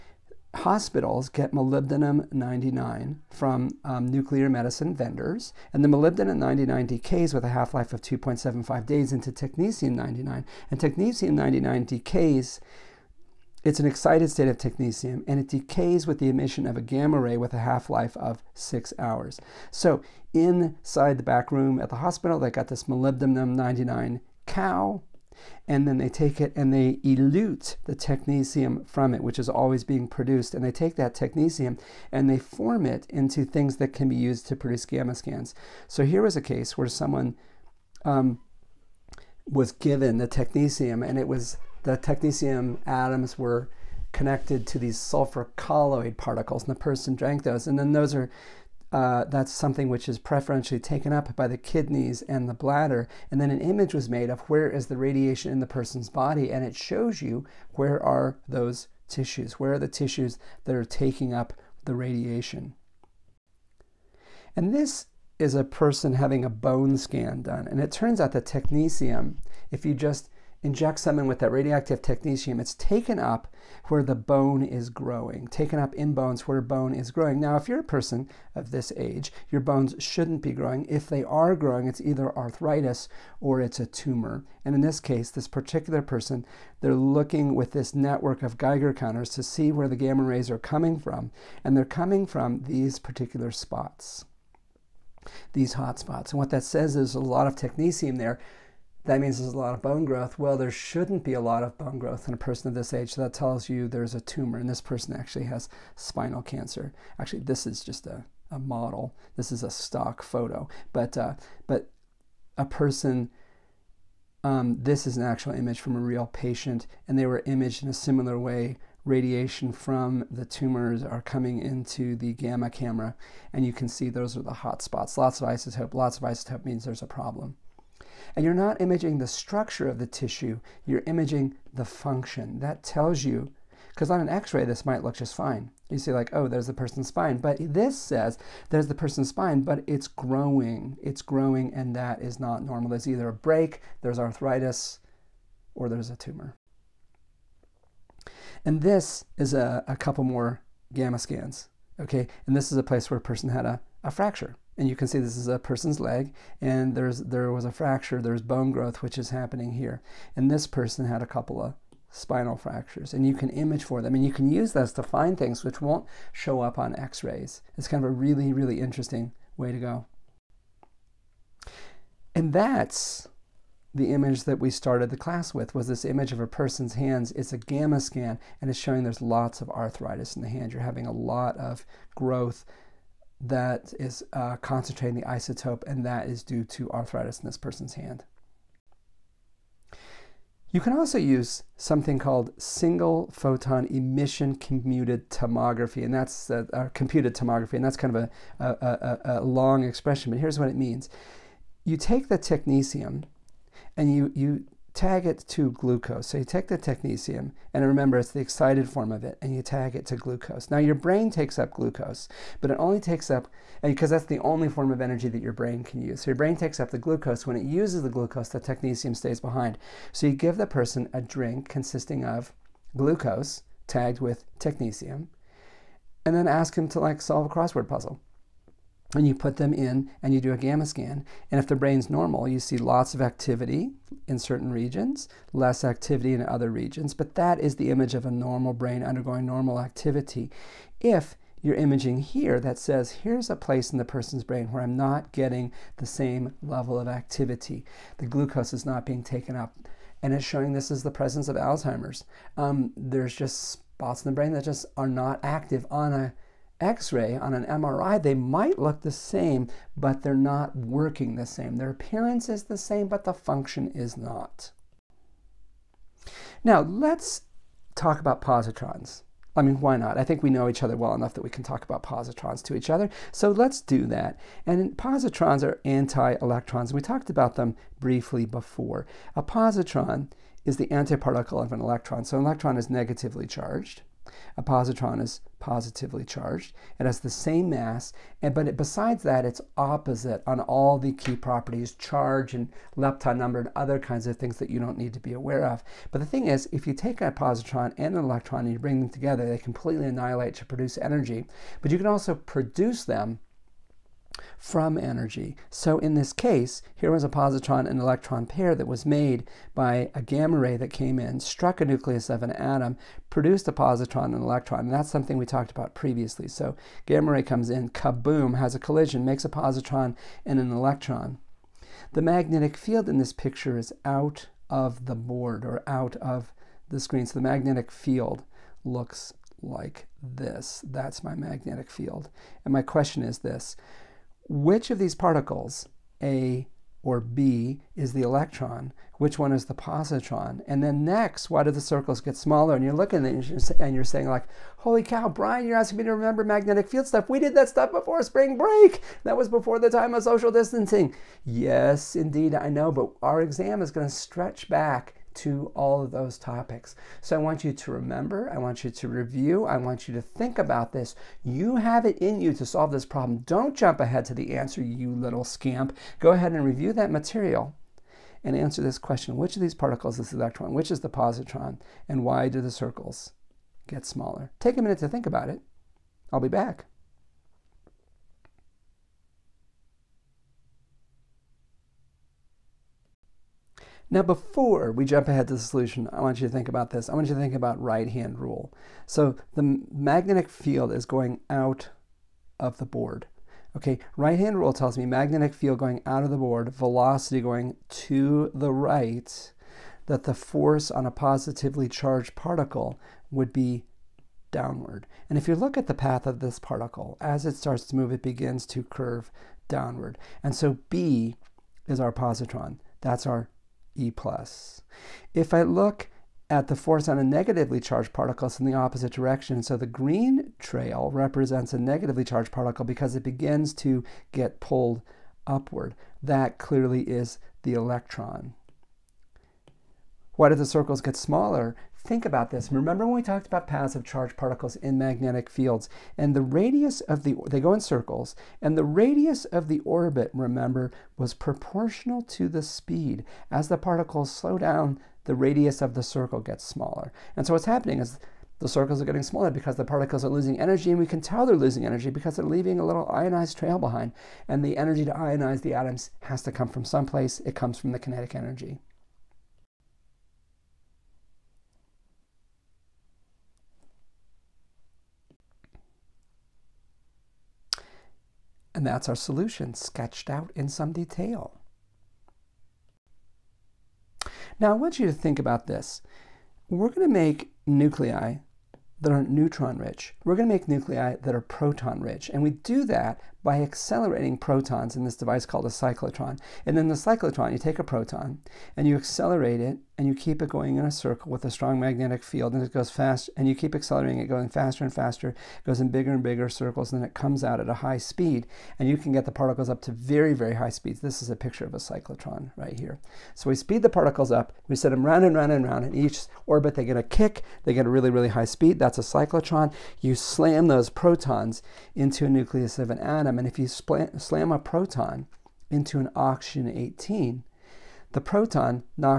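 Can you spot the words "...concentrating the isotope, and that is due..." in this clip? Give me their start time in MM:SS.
03:04.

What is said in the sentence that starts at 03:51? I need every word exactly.
And if the brain's normal, you see lots of activity in certain regions, less activity in other regions.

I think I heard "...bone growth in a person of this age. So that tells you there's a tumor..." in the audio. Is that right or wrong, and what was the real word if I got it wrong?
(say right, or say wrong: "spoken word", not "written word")
right.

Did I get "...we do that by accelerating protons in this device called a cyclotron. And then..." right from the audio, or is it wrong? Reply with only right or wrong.
right.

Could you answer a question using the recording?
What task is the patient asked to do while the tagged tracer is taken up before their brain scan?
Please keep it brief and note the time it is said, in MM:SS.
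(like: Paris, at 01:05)
solve a crossword puzzle, at 03:47.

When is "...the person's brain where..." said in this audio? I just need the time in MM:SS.
04:03.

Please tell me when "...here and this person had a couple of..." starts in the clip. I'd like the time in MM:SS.
02:39.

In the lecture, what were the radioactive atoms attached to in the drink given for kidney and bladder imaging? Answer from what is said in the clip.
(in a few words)
sulfur colloid particles.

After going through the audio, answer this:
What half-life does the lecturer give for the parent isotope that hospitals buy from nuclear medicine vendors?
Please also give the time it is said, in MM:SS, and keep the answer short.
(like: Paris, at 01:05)
2.75 days, at 00:08.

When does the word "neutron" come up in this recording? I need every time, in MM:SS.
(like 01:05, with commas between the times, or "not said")
07:59.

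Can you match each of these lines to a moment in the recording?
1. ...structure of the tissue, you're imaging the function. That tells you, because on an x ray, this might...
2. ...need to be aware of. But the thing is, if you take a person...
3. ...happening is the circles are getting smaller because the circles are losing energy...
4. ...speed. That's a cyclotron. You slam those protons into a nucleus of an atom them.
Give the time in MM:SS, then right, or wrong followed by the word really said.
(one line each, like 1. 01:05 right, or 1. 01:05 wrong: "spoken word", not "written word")
1. 02:09 right
2. 04:54 wrong: "positron", not "person"
3. 07:27 wrong: "particles", not "circles"
4. 08:28 right.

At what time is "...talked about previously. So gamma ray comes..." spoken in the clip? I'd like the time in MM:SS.
05:15.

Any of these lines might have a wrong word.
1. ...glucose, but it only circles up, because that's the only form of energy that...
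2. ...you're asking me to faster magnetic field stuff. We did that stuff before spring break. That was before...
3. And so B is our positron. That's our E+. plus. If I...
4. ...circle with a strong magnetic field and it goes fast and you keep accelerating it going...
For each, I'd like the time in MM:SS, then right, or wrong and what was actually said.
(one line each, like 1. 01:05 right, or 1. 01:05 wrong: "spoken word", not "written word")
1. 03:31 wrong: "takes", not "circles"
2. 05:45 wrong: "remember", not "faster"
3. 06:50 right
4. 08:10 right.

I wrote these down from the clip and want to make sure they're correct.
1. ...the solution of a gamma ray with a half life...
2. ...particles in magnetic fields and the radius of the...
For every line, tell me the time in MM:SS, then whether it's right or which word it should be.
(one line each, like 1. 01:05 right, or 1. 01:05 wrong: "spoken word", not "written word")
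1. 00:16 wrong: "emission", not "solution"
2. 07:14 right.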